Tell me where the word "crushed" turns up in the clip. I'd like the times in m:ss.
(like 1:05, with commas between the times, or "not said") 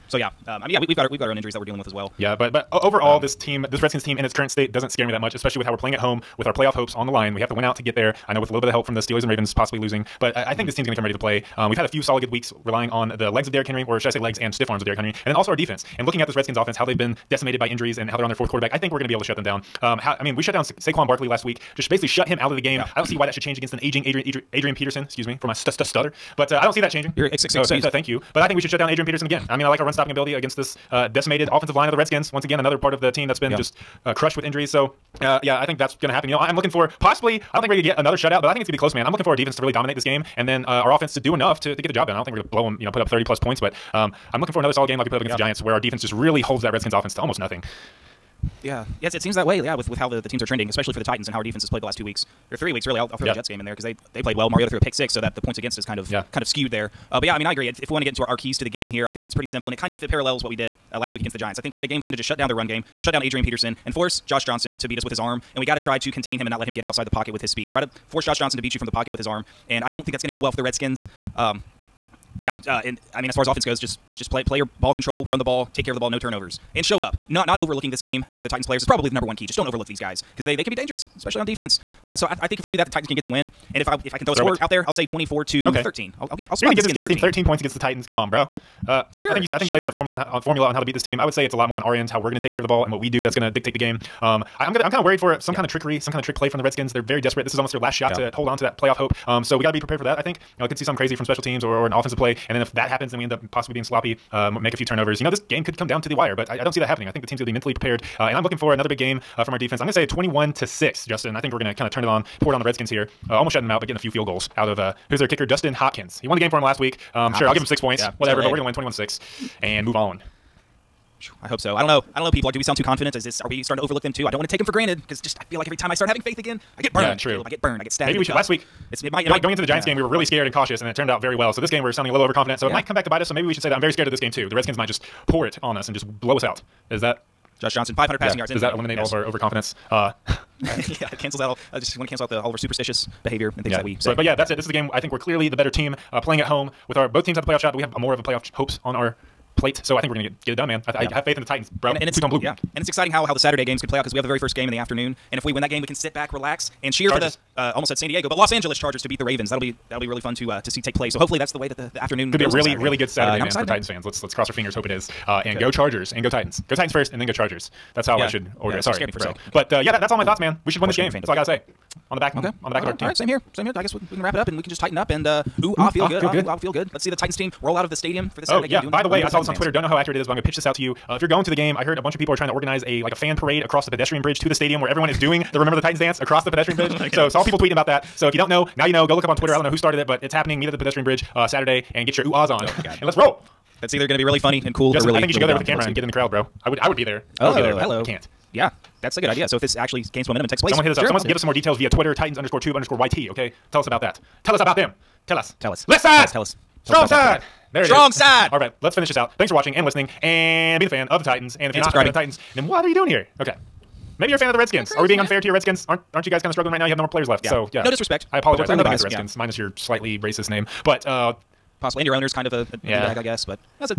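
0:34.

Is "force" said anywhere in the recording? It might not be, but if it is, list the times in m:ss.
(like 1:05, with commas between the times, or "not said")
1:03, 1:08.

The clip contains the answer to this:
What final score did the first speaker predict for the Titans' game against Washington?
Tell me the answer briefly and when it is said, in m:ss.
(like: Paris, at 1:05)
24 to 13, at 1:25.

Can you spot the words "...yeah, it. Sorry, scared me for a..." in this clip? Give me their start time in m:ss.
2:48.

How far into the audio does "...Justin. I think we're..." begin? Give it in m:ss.
1:51.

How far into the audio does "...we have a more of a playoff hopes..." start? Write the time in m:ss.
2:27.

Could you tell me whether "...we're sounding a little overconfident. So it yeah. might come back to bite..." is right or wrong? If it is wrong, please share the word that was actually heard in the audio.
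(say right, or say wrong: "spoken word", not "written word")
right.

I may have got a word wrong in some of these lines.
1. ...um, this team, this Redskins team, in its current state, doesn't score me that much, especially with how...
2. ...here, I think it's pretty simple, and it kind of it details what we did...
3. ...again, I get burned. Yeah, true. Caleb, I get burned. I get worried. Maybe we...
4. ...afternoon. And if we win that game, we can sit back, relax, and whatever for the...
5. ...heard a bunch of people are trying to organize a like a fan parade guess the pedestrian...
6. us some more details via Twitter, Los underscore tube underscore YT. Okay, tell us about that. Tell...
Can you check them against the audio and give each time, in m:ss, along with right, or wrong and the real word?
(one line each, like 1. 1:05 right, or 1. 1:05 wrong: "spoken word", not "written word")
1. 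0:03 wrong: "scare", not "score"
2. 0:58 wrong: "parallels", not "details"
3. 2:06 wrong: "stabbed", not "worried"
4. 2:34 wrong: "cheer", not "whatever"
5. 3:01 wrong: "across", not "guess"
6. 3:21 wrong: "Titans", not "Los".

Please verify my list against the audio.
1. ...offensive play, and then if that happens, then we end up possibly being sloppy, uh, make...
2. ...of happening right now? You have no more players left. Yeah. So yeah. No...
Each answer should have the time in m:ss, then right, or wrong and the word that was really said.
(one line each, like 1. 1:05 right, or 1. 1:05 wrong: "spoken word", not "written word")
1. 1:41 right
2. 3:36 wrong: "struggling", not "happening".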